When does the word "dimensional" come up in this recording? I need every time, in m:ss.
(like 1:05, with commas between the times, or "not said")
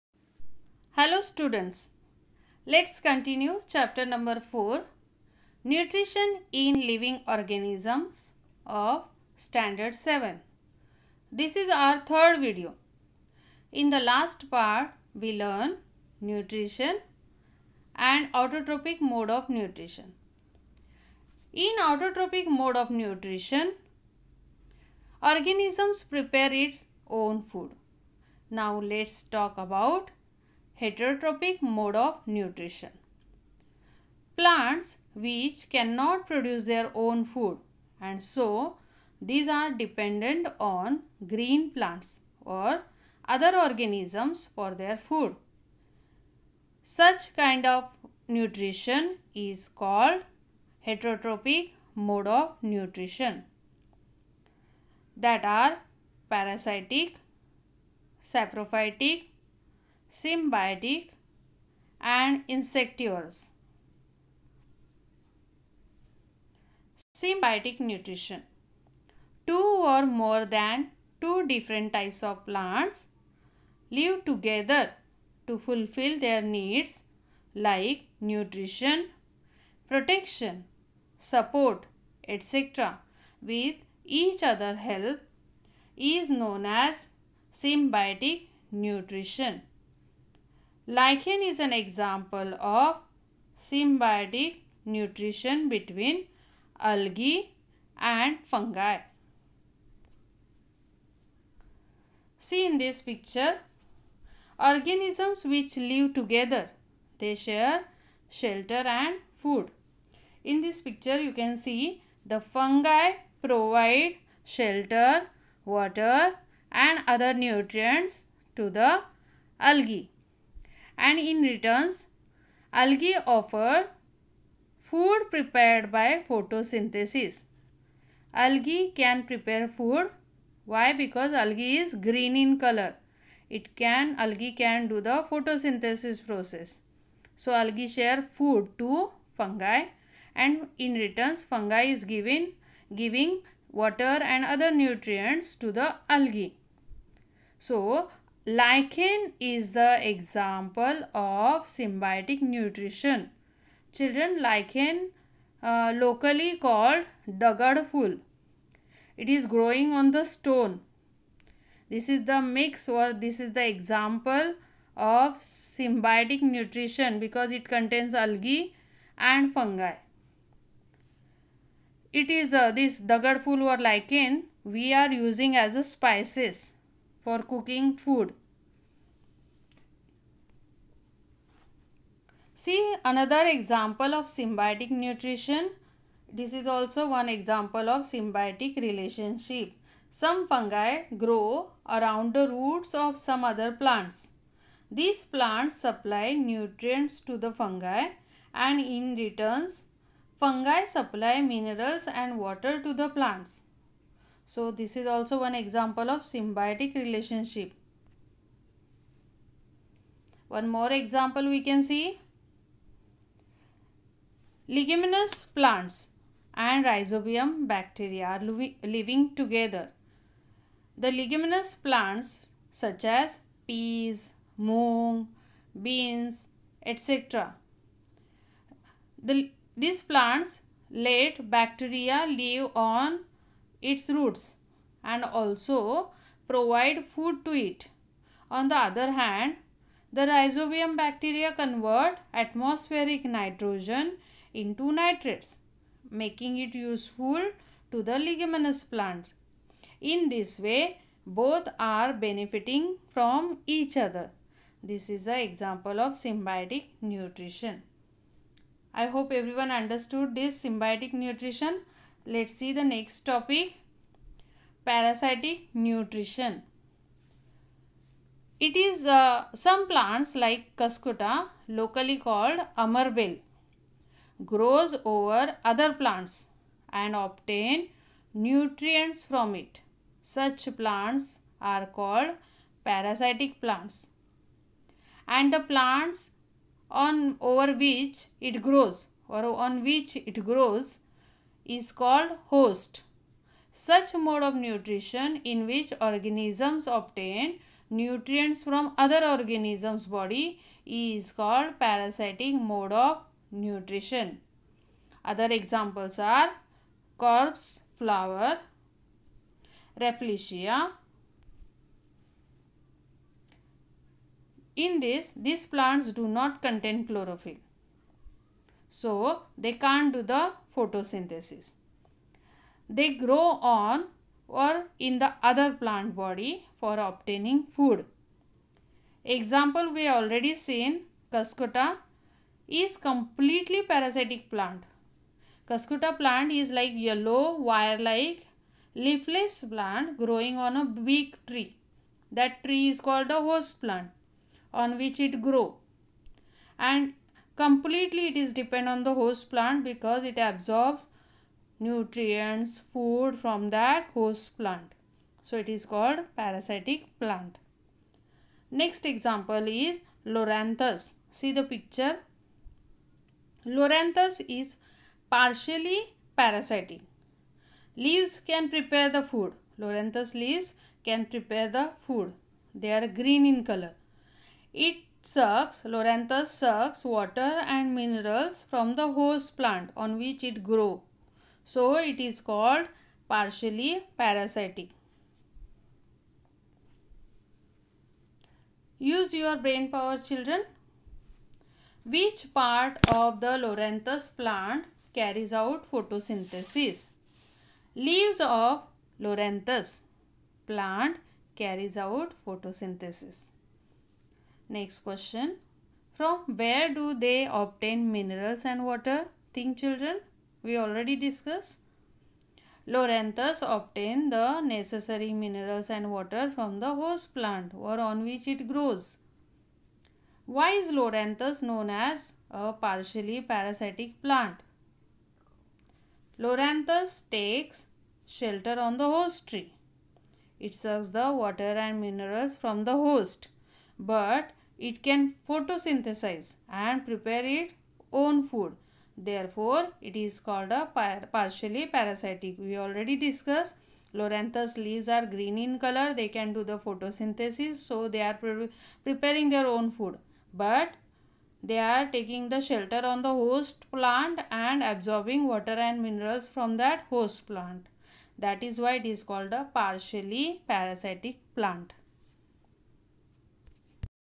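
not said.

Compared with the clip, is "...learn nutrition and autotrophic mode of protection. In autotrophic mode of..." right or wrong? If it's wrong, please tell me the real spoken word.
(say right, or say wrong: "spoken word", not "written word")
wrong: "nutrition", not "protection".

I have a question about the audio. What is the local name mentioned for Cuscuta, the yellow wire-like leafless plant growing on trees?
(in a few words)
Amarbel.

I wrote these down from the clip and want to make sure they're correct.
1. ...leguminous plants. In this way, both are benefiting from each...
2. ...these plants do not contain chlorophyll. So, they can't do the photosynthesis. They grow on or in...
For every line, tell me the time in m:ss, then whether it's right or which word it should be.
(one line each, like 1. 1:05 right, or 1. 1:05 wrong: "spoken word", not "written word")
1. 4:08 right
2. 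5:15 right.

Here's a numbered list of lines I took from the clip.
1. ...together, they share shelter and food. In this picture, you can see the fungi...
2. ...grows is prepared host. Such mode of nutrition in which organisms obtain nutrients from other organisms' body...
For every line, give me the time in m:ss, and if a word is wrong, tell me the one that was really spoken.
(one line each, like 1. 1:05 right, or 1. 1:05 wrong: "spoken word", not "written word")
1. 1:46 right
2. 4:50 wrong: "called", not "prepared".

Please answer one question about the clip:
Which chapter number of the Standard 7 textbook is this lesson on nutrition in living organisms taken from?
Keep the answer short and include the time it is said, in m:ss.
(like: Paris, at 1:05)
4, at 0:04.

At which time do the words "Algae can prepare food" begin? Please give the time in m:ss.
2:08.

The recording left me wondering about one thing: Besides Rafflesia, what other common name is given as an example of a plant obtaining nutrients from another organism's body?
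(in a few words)
corpse flower.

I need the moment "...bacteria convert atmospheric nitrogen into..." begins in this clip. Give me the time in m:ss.
4:00.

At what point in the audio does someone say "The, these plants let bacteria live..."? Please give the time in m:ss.
3:49.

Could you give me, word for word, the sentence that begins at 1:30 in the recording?
Lichen is an example of symbiotic nutrition between algae and fungi.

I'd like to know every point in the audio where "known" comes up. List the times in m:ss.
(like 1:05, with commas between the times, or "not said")
1:26, 7:01.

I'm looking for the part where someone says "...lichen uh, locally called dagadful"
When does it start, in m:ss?
2:34.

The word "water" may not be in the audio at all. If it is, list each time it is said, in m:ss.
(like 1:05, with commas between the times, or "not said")
1:55, 2:23, 3:22, 6:17, 6:48, 6:56, 7:11, 7:35.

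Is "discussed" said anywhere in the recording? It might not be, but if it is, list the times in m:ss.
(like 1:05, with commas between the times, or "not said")
6:51, 7:23.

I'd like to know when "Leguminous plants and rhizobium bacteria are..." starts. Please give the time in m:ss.
3:34.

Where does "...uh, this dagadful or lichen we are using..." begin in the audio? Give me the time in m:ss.
2:52.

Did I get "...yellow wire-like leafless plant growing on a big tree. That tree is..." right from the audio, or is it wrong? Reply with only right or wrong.
right.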